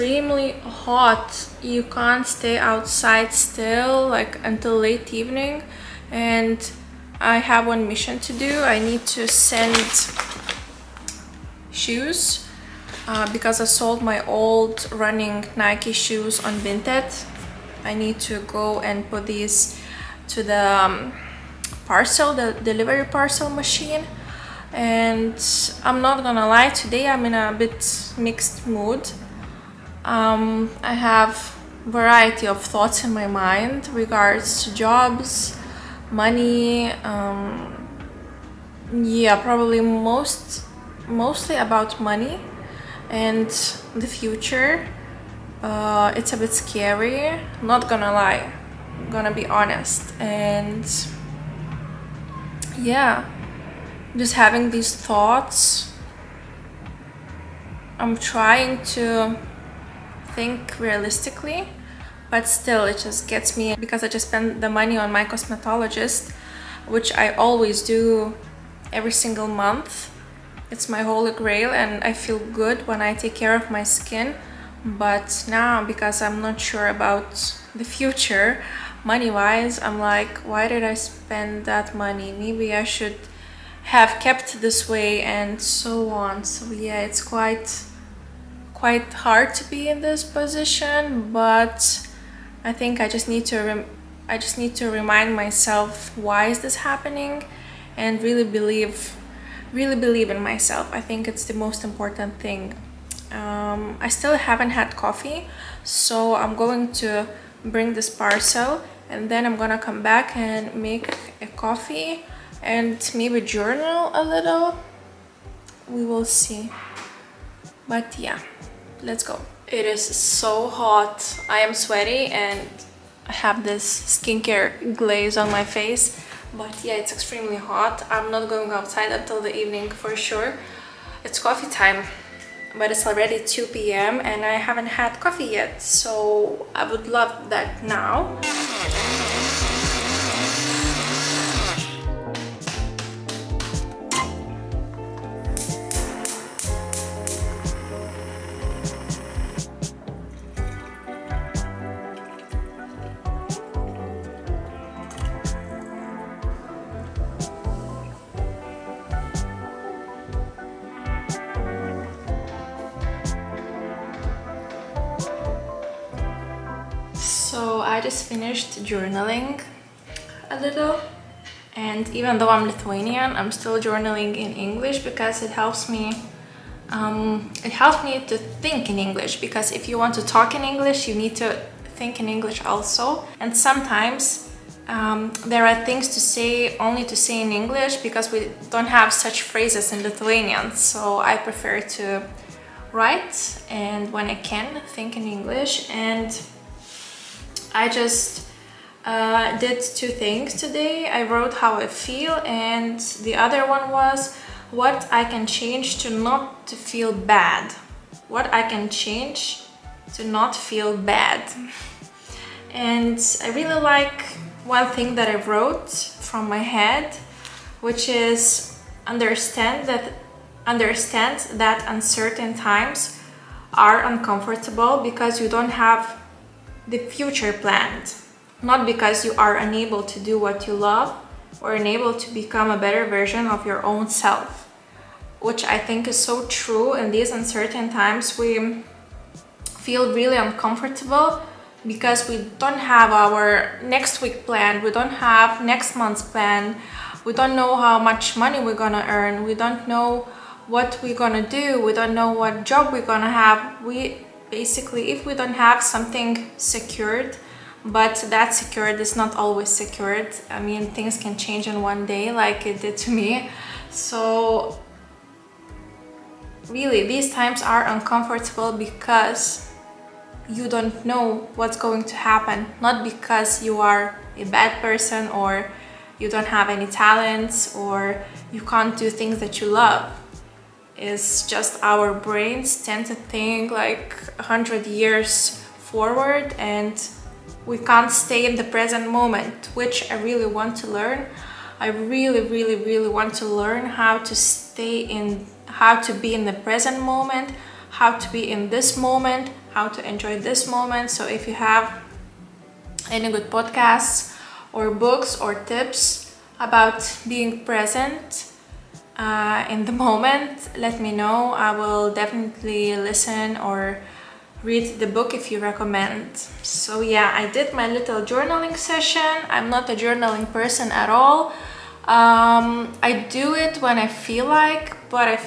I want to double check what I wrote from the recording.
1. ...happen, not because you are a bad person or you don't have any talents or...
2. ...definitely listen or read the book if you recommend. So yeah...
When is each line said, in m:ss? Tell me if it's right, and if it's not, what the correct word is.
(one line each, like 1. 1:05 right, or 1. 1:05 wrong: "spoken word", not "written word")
1. 4:32 right
2. 5:12 right.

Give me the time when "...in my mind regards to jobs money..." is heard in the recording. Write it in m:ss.
0:33.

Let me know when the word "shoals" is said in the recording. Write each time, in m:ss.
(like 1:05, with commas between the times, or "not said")
not said.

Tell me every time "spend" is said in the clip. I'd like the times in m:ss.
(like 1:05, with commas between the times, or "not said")
1:04, 1:20.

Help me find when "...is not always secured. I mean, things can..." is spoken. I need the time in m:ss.
4:19.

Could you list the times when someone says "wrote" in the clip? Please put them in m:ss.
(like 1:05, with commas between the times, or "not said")
3:21, 3:35.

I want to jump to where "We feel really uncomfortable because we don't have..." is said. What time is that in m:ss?
3:58.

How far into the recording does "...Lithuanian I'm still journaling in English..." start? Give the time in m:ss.
2:52.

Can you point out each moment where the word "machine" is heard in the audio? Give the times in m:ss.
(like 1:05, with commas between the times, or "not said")
0:23.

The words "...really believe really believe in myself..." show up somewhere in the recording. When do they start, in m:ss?
1:38.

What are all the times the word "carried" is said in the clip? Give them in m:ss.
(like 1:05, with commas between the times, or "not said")
not said.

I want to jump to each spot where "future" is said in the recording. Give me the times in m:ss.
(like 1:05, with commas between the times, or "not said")
0:44, 1:17, 3:46.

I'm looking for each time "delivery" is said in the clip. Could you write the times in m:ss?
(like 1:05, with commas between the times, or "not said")
0:22.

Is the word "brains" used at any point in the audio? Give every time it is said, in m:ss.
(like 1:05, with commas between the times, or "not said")
4:42.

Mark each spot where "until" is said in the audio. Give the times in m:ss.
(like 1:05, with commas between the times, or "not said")
0:04, 2:09.